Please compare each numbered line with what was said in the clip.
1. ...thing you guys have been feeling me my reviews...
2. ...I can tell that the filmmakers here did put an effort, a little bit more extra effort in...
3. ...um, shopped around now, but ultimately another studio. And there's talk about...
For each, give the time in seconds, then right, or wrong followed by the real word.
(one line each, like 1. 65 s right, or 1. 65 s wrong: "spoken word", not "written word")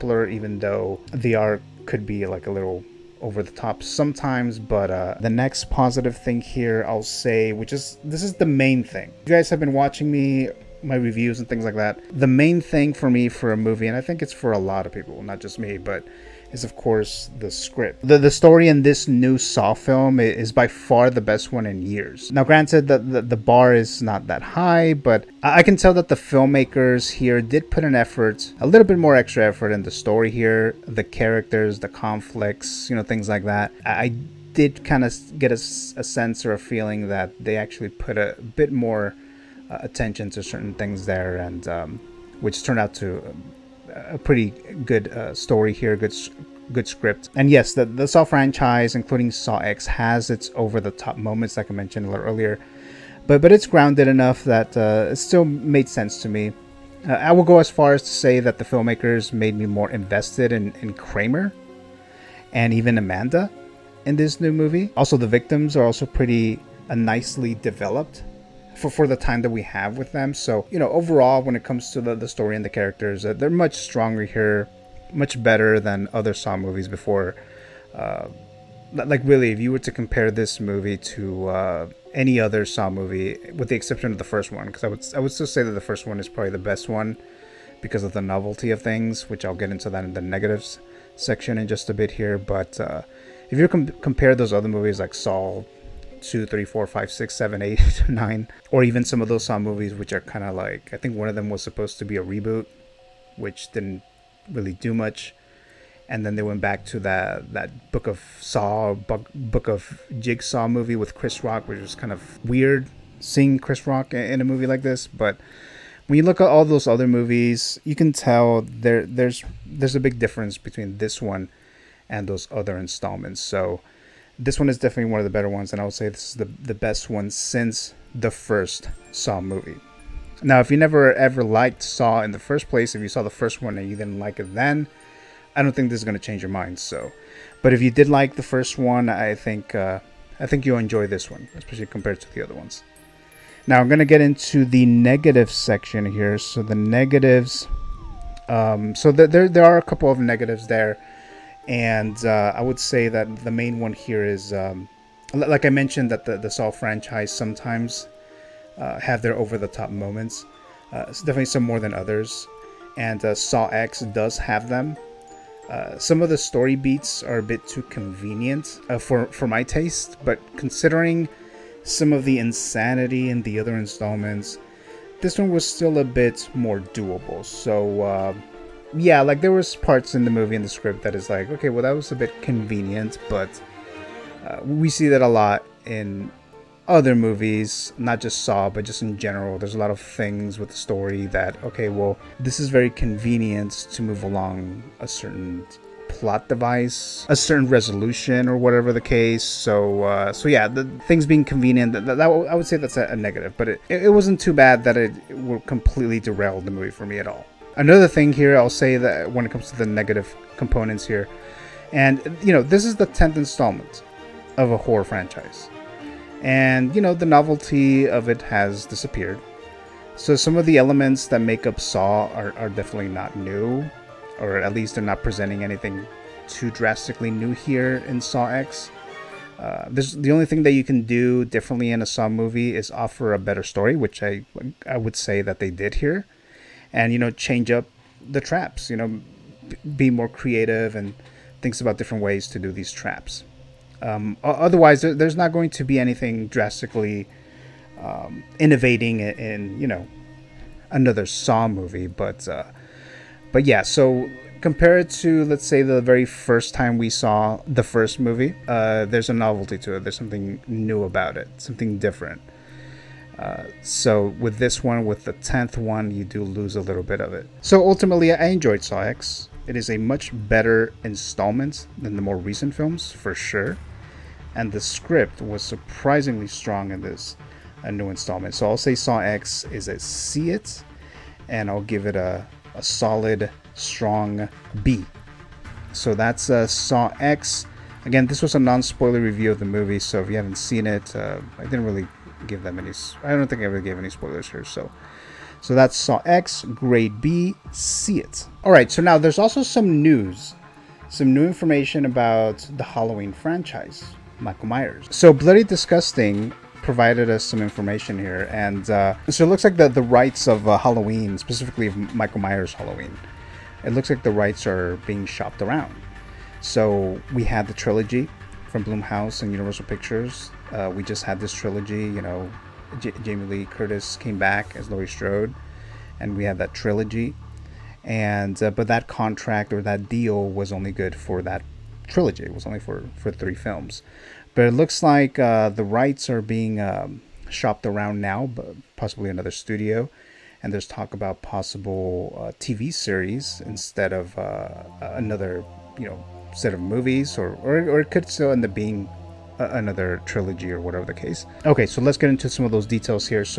1. 8 s wrong: "watching", not "feeling"
2. 25 s right
3. 336 s wrong: "possibly", not "ultimately".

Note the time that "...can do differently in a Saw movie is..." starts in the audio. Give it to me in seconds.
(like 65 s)
230 s.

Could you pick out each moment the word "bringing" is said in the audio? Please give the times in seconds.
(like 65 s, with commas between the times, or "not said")
not said.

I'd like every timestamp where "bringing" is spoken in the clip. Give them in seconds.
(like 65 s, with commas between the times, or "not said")
not said.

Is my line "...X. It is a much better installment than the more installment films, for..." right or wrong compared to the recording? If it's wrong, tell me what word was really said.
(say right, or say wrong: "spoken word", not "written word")
wrong: "recent", not "installment".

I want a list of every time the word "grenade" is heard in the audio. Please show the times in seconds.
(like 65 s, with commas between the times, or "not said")
not said.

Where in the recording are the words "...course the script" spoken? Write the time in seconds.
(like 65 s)
16 s.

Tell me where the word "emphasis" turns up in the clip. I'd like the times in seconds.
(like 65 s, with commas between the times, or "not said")
not said.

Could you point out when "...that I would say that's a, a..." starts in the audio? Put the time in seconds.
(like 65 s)
202 s.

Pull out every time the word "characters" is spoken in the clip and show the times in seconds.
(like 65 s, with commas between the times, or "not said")
31 s, 72 s.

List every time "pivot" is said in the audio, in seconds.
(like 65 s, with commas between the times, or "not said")
not said.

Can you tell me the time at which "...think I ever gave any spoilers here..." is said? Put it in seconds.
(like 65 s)
293 s.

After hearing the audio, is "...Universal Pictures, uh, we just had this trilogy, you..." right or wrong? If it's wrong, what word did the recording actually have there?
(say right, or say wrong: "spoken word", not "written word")
right.